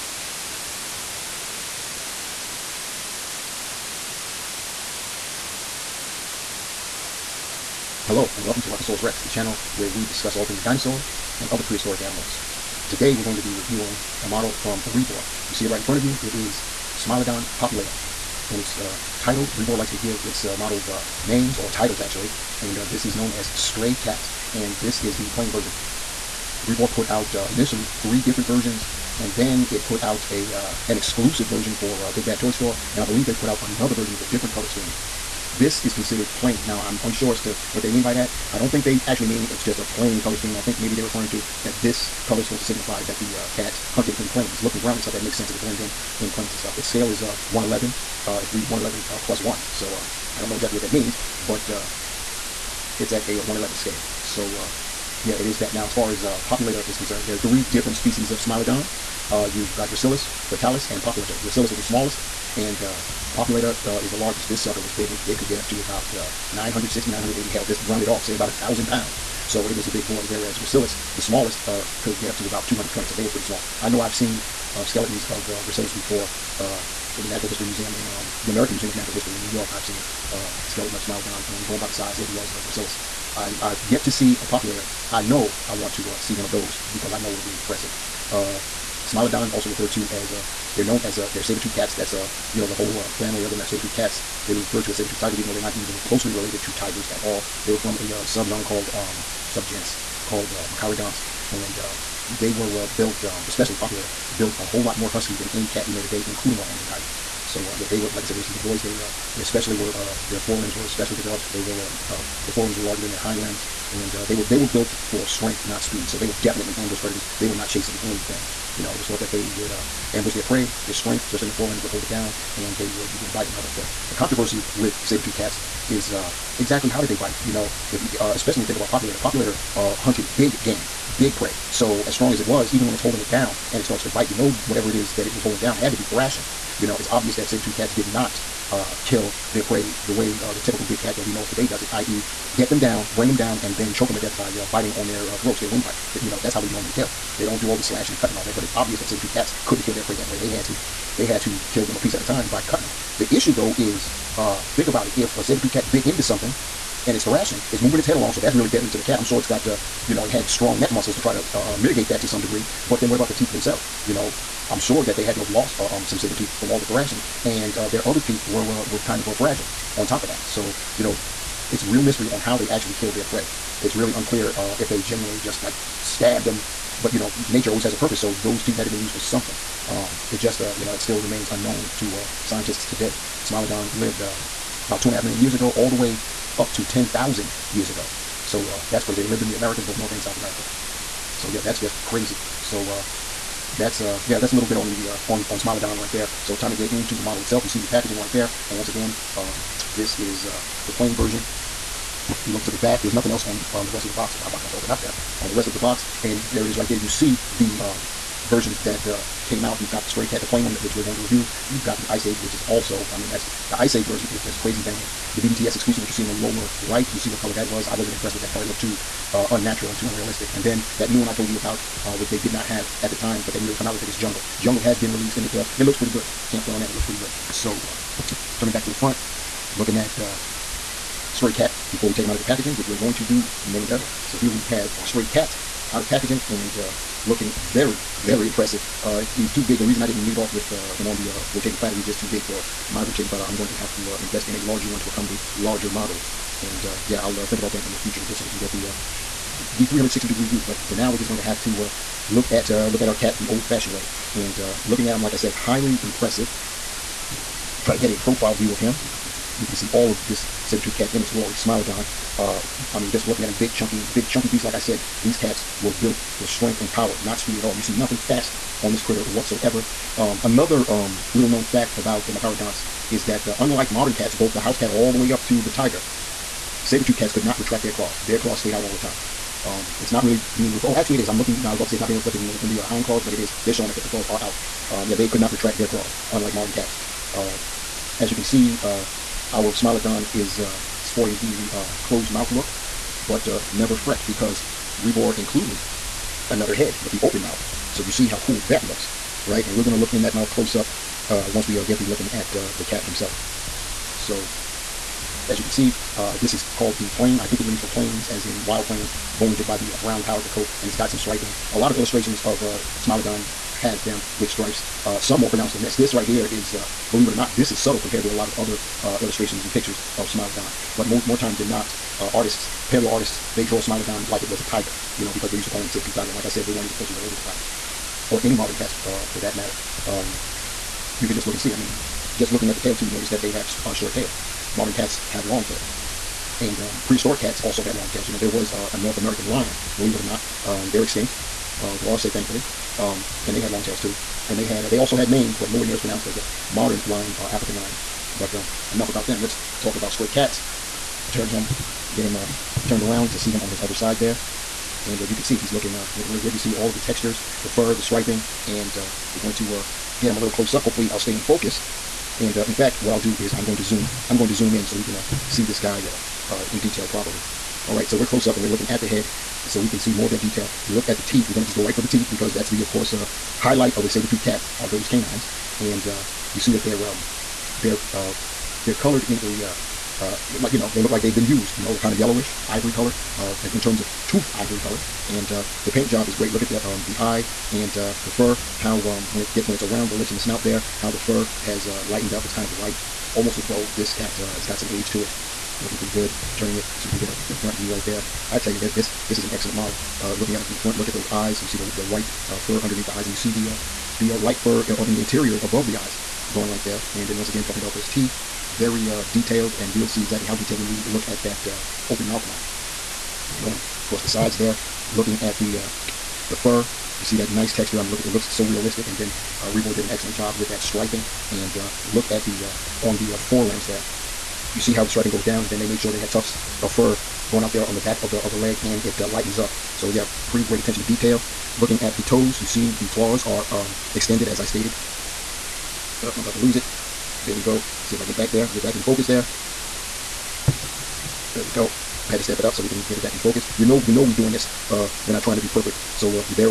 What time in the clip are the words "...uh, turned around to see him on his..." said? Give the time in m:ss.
5:52.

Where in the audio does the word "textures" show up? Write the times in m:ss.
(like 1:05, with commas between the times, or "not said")
5:56, 6:57.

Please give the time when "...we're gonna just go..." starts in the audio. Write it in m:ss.
6:11.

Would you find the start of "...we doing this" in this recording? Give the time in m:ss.
7:24.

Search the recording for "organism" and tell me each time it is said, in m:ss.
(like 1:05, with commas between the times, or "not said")
not said.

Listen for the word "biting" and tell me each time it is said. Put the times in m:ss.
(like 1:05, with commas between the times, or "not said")
2:03, 2:24.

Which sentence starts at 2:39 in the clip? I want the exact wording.
I'm sure it's got, uh, you know, it had strong neck muscles to try to uh, uh, mitigate that to some degree.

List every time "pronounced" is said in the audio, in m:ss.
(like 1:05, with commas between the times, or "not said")
5:15, 5:45.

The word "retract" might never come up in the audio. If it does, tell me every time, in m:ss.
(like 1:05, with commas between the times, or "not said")
4:37, 4:45.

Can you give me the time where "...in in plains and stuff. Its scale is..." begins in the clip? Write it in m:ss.
0:45.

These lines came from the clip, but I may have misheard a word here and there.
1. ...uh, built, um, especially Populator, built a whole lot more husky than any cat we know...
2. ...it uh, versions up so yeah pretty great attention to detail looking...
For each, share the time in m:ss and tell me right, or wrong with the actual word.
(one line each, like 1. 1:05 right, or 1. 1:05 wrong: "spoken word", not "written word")
1. 1:42 right
2. 7:09 wrong: "lightens", not "versions".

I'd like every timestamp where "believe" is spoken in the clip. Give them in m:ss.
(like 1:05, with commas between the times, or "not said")
0:33, 5:17, 5:39.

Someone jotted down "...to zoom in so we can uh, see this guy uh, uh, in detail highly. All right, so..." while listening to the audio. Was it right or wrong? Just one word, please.
wrong.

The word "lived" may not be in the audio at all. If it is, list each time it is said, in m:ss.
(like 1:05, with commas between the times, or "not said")
3:03, 3:09.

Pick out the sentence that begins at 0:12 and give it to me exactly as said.
Today, we're going to be reviewing a model from Rebor.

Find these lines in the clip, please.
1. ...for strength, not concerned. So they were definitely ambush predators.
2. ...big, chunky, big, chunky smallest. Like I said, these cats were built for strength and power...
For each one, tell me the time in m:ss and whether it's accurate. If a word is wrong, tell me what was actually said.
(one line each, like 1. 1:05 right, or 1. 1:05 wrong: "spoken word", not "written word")
1. 1:54 wrong: "speed", not "concerned"
2. 4:23 wrong: "beast", not "smallest".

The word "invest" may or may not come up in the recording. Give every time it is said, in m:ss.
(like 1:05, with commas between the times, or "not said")
4:04.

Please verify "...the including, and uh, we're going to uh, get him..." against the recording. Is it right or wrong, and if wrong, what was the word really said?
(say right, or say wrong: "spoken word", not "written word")
wrong: "striping", not "including".